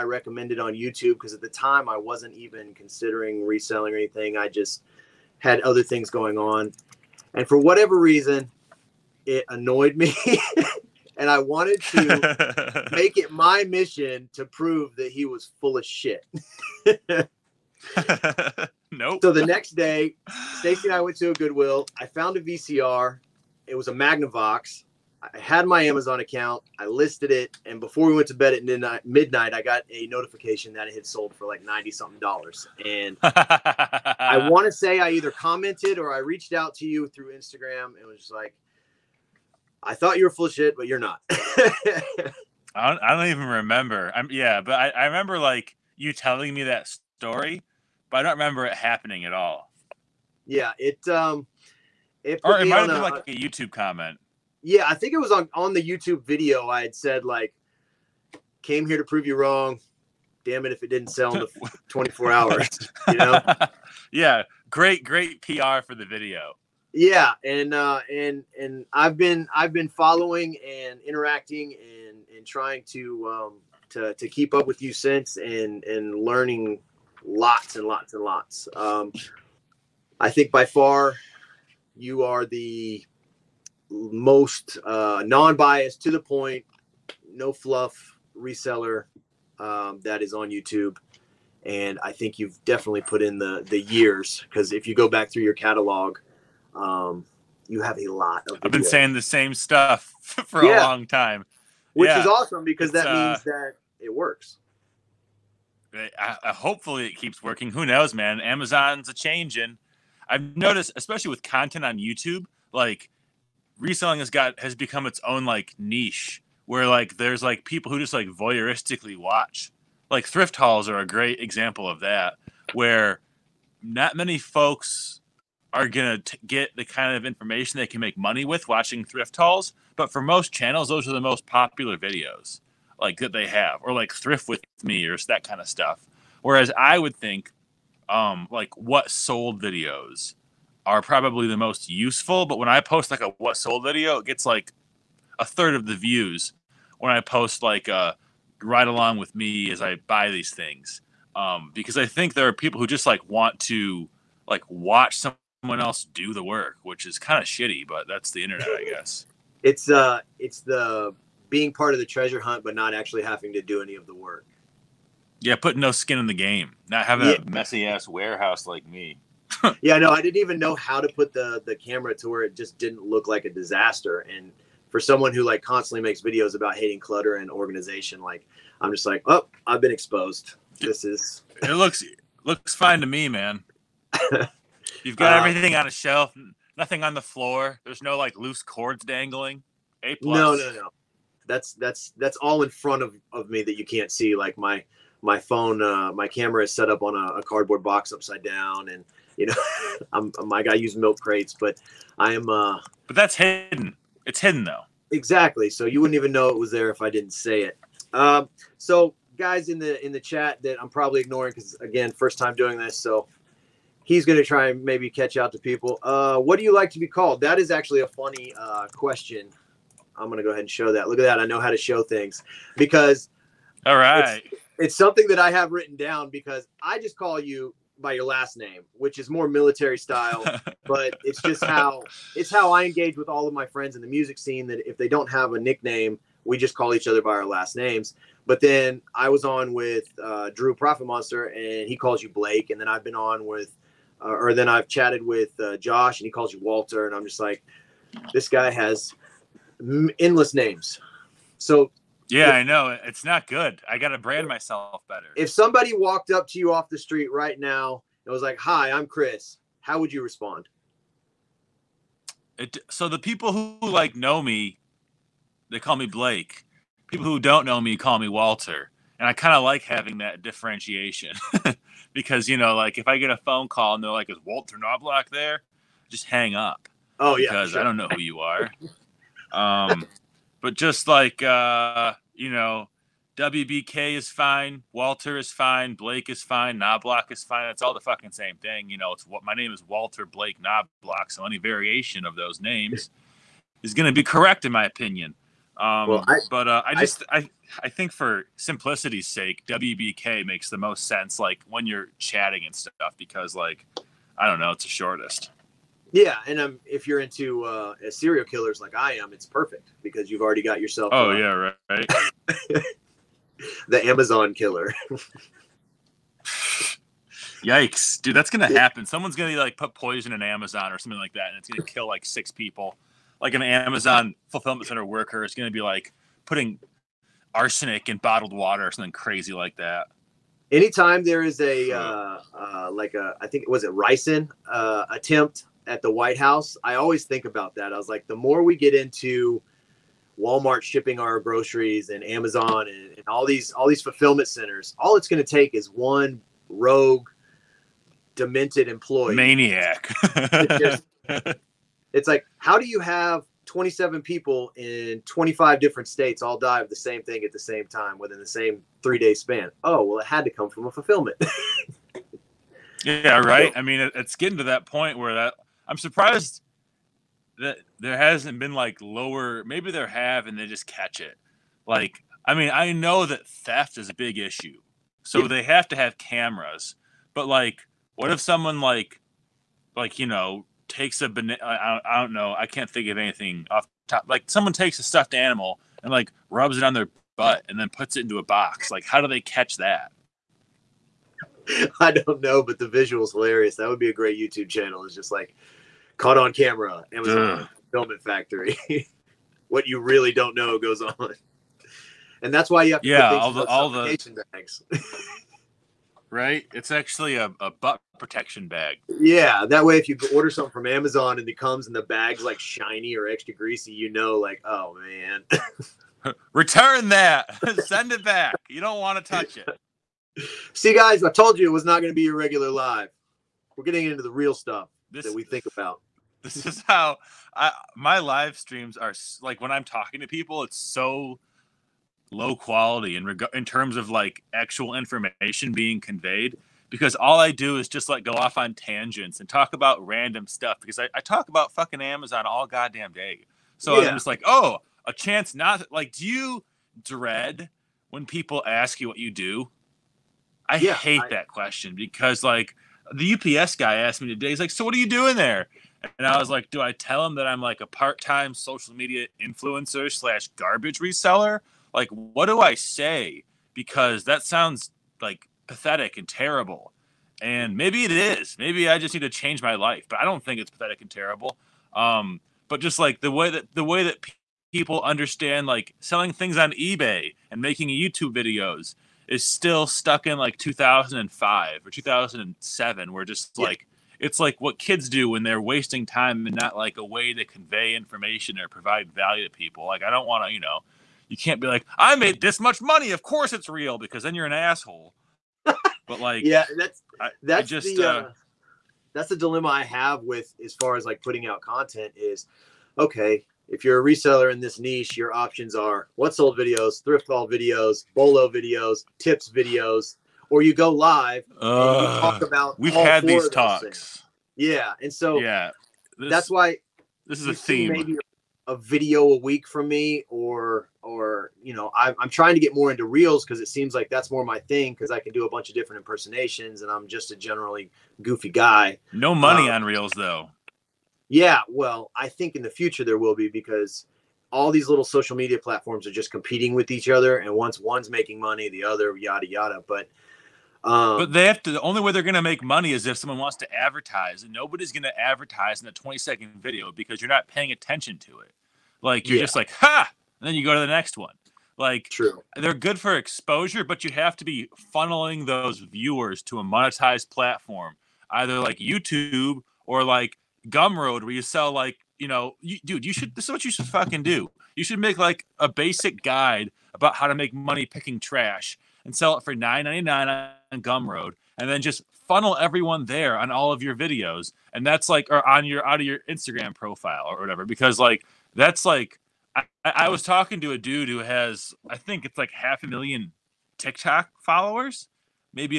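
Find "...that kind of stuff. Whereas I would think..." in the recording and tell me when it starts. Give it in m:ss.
2:15.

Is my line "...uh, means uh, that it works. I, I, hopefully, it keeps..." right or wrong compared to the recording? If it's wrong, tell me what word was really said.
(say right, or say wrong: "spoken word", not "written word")
right.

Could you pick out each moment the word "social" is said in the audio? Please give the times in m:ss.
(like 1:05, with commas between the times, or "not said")
7:38, 8:55.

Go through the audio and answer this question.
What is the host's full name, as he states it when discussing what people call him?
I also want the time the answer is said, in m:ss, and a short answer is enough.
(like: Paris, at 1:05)
Walter Blake Knoblock, at 4:49.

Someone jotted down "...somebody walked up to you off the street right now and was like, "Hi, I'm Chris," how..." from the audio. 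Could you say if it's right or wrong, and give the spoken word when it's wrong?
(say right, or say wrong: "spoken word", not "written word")
right.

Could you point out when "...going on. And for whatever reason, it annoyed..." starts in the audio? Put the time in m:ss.
0:06.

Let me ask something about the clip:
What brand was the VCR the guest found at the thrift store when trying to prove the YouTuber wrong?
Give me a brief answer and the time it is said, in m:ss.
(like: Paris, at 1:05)
Magnavox, at 0:23.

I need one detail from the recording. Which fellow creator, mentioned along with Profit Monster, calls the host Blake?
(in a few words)
Drew.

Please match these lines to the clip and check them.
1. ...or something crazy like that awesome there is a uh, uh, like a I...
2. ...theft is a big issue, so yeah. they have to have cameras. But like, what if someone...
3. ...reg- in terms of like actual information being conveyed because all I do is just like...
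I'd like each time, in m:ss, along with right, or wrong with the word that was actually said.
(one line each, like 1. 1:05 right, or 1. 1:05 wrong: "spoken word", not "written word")
1. 5:28 wrong: "anytime", not "awesome"
2. 6:13 right
3. 7:13 right.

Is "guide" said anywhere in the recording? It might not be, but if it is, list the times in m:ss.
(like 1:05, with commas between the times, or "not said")
9:26.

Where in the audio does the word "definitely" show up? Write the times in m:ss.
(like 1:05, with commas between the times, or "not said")
1:32.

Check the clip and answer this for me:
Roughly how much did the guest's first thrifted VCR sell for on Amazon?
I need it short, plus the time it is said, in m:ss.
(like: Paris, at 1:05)
ninety something dollars, at 0:31.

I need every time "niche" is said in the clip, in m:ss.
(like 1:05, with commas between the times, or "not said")
1:55, 8:24.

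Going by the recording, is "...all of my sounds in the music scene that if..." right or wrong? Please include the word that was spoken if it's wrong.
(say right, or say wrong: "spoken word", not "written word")
wrong: "friends", not "sounds".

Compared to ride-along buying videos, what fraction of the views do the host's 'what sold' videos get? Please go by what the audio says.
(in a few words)
a third.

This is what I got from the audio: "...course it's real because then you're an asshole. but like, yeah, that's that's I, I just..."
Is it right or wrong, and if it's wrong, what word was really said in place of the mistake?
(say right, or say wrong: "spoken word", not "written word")
right.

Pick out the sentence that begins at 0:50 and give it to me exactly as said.
Yeah, it um, it or it might have been a, like a YouTube comment.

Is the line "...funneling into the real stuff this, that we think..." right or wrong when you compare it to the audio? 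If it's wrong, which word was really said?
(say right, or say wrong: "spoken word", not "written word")
wrong: "getting", not "funneling".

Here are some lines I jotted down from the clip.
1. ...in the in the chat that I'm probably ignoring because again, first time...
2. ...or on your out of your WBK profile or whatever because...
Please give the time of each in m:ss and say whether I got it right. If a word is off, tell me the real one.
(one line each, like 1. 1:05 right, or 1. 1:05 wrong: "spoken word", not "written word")
1. 3:29 right
2. 9:35 wrong: "Instagram", not "WBK".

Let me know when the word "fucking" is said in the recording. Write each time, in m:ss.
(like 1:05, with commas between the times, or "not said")
4:47, 7:21, 9:23.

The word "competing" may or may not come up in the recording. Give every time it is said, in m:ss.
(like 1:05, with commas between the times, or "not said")
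8:56.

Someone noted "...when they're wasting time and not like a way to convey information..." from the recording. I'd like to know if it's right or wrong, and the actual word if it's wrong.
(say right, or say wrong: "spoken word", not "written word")
right.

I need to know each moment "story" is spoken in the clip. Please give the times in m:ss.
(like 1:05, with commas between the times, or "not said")
0:46.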